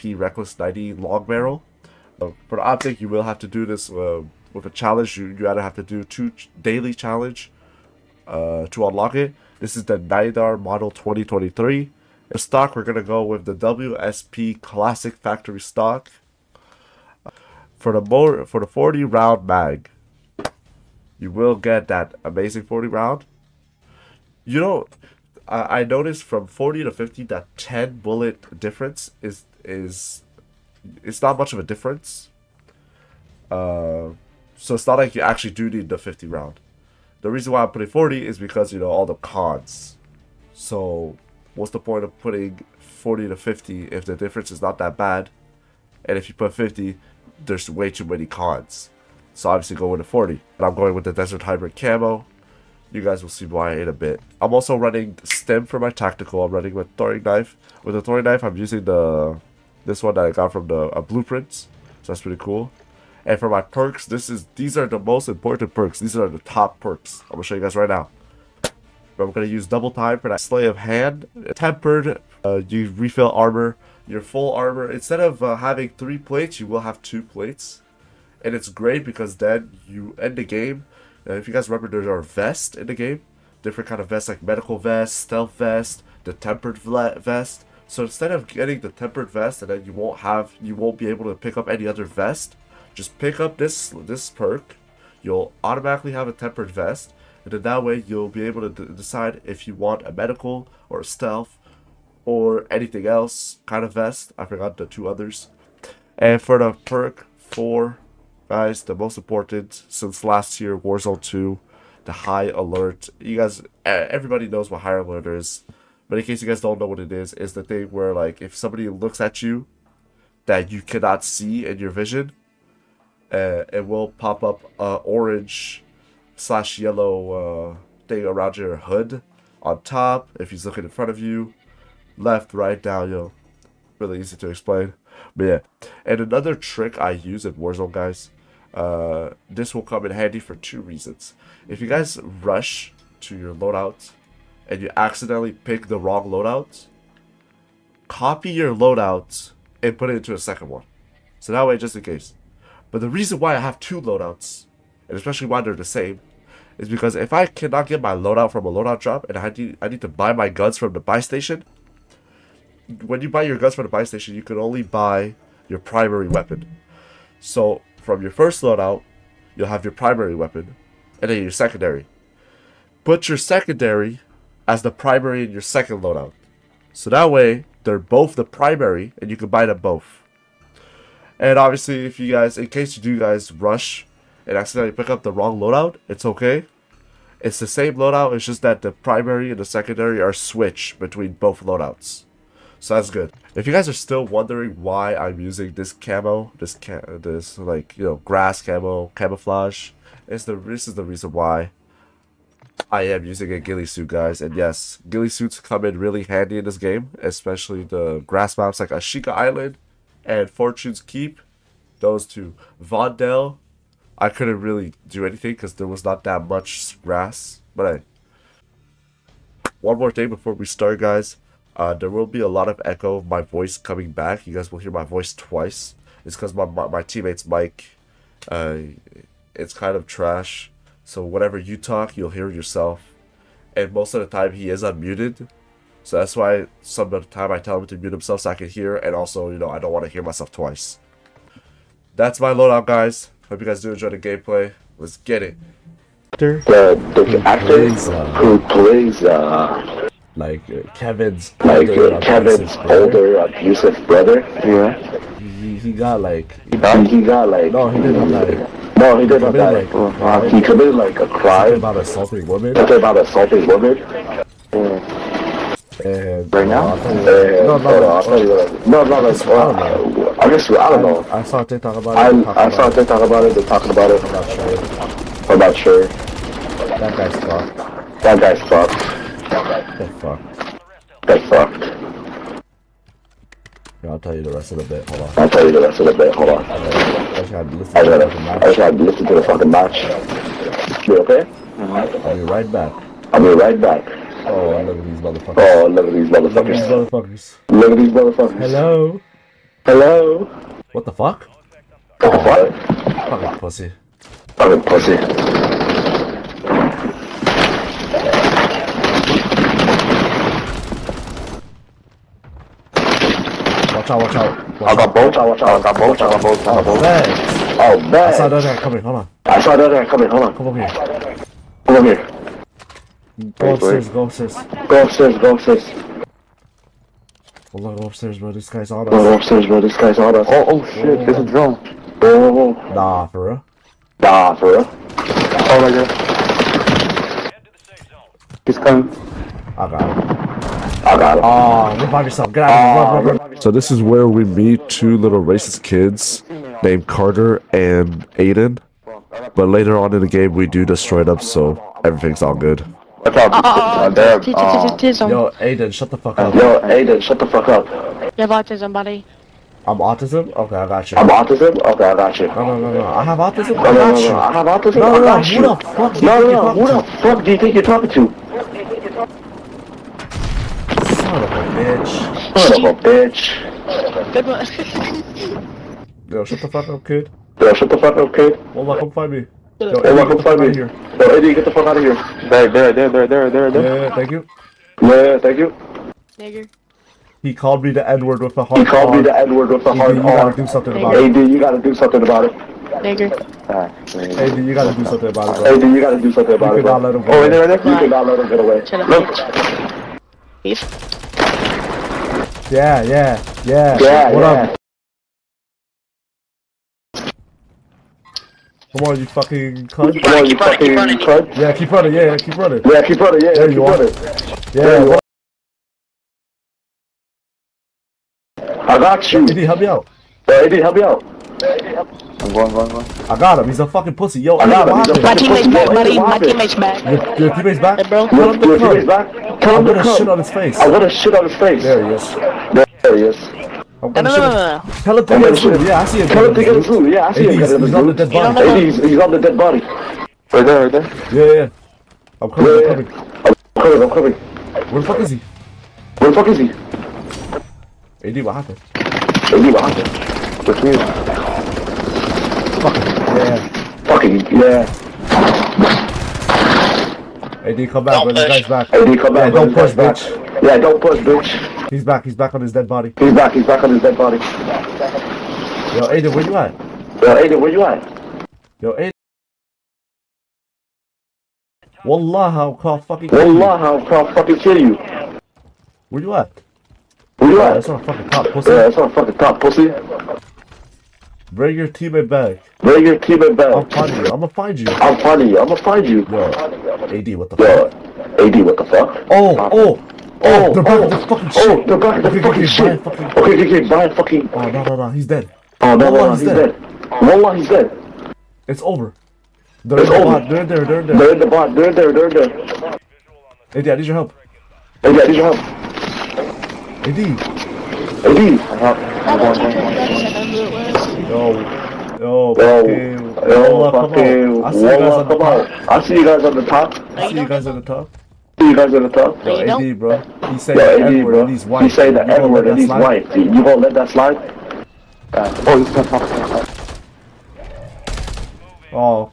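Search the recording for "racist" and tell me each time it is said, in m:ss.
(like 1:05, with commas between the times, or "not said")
5:45.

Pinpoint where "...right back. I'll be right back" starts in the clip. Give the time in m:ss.
4:52.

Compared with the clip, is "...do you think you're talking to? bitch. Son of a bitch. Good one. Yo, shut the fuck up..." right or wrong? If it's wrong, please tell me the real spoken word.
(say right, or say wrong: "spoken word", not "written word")
right.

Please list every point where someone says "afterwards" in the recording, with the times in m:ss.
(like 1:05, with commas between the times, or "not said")
not said.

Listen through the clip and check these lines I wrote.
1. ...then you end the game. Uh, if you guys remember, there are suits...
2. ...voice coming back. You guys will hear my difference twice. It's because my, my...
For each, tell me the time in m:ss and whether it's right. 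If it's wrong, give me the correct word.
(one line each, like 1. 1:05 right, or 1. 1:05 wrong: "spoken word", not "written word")
1. 1:19 wrong: "vests", not "suits"
2. 3:43 wrong: "voice", not "difference".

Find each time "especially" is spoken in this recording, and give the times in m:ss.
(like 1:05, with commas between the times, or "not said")
2:35, 3:27.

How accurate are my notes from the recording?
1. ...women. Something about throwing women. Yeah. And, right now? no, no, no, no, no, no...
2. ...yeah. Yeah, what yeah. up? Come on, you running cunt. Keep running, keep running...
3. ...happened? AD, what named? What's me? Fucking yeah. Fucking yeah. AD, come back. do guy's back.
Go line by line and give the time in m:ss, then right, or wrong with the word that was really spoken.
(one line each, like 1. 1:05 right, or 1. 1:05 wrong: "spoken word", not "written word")
1. 4:22 wrong: "assaulting", not "throwing"
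2. 6:43 wrong: "fucking", not "running"
3. 7:28 wrong: "happened", not "named".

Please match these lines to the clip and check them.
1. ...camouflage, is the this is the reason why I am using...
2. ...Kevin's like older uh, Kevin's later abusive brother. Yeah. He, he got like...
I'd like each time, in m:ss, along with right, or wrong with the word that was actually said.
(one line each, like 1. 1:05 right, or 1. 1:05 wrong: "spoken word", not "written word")
1. 3:19 right
2. 4:10 wrong: "older", not "later".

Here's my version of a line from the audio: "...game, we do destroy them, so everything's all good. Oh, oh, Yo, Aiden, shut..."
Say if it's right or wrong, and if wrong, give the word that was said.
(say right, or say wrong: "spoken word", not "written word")
right.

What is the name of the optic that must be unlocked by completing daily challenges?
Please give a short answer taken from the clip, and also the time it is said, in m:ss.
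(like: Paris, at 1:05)
Nydar Model 2023, at 0:09.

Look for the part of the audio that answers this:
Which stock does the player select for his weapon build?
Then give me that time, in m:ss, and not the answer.
0:13.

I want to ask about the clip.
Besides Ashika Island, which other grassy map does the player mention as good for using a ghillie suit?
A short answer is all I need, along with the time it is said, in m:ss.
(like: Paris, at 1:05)
Fortune's Keep, at 3:30.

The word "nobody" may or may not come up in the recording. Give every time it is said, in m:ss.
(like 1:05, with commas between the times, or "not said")
not said.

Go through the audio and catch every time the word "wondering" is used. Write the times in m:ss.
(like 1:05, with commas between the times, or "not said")
3:14.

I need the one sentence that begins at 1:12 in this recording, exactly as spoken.
Uh, you refill armor, your full armor.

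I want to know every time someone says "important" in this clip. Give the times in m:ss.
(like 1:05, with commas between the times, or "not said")
1:05, 1:49.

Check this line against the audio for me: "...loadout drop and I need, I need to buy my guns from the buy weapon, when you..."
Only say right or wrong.
wrong.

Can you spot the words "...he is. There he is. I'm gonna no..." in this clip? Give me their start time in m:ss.
7:12.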